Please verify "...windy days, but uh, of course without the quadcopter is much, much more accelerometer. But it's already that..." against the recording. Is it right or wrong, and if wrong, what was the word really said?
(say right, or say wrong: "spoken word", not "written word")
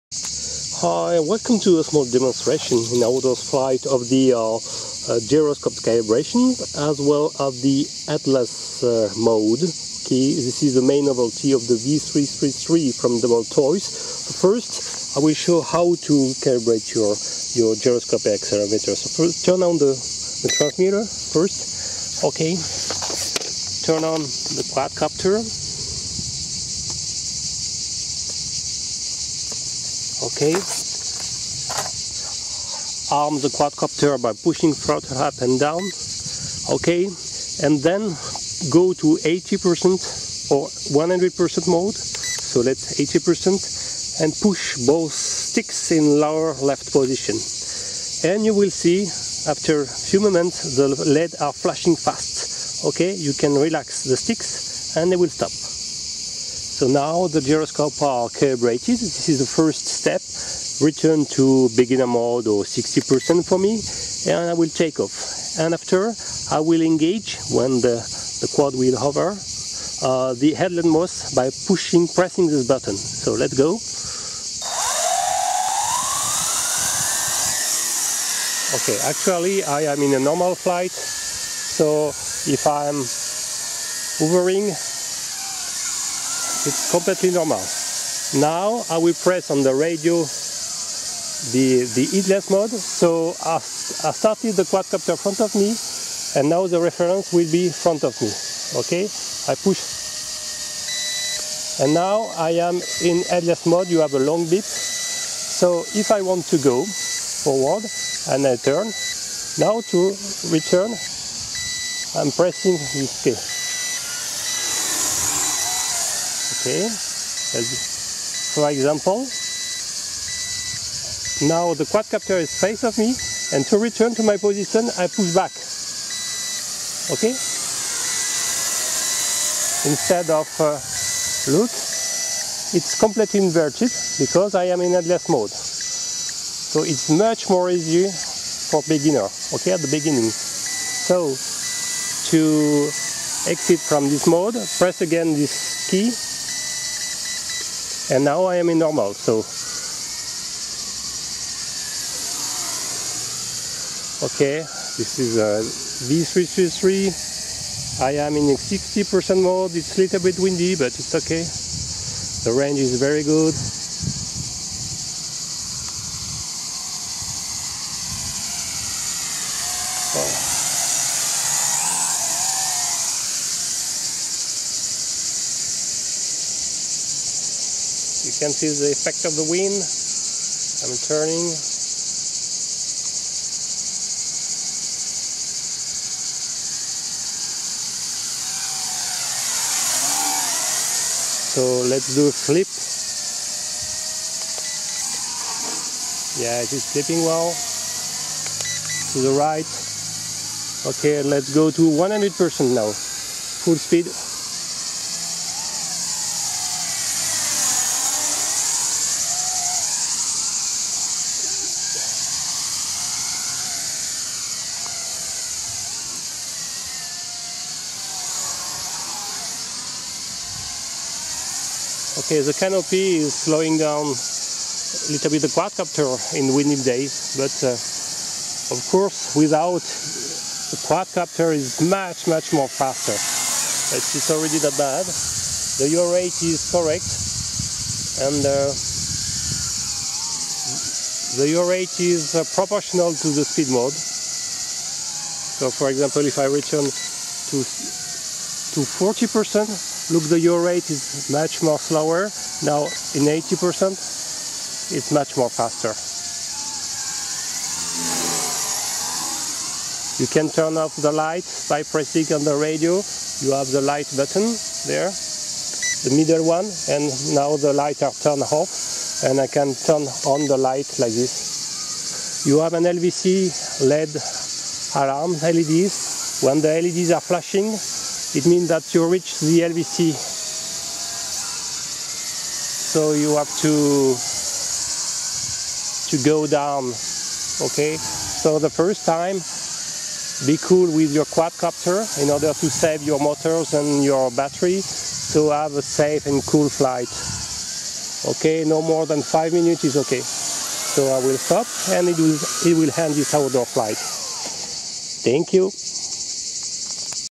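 wrong: "faster", not "accelerometer".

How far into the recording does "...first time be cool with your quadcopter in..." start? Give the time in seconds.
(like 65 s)
288 s.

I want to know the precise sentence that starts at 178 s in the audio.
you can see the effect of the wind.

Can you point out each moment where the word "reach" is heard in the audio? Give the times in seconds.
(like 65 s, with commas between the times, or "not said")
279 s.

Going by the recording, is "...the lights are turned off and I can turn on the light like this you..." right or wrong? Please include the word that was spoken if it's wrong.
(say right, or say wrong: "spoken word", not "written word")
right.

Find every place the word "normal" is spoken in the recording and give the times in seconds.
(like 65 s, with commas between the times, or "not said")
80 s, 87 s, 148 s.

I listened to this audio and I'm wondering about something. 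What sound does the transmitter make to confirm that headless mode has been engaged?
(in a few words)
a long beep.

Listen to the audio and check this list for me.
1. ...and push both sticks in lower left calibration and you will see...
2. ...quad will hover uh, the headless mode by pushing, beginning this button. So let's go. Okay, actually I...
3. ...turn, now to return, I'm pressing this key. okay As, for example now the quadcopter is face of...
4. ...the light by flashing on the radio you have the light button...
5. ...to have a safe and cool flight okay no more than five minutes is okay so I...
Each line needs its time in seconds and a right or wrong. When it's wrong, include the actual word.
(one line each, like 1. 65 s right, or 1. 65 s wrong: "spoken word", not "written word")
1. 44 s wrong: "position", not "calibration"
2. 68 s wrong: "pressing", not "beginning"
3. 108 s right
4. 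261 s wrong: "pressing", not "flashing"
5. 295 s right.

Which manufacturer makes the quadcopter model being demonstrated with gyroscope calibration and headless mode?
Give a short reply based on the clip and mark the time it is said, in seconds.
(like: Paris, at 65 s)
WL Toys, at 13 s.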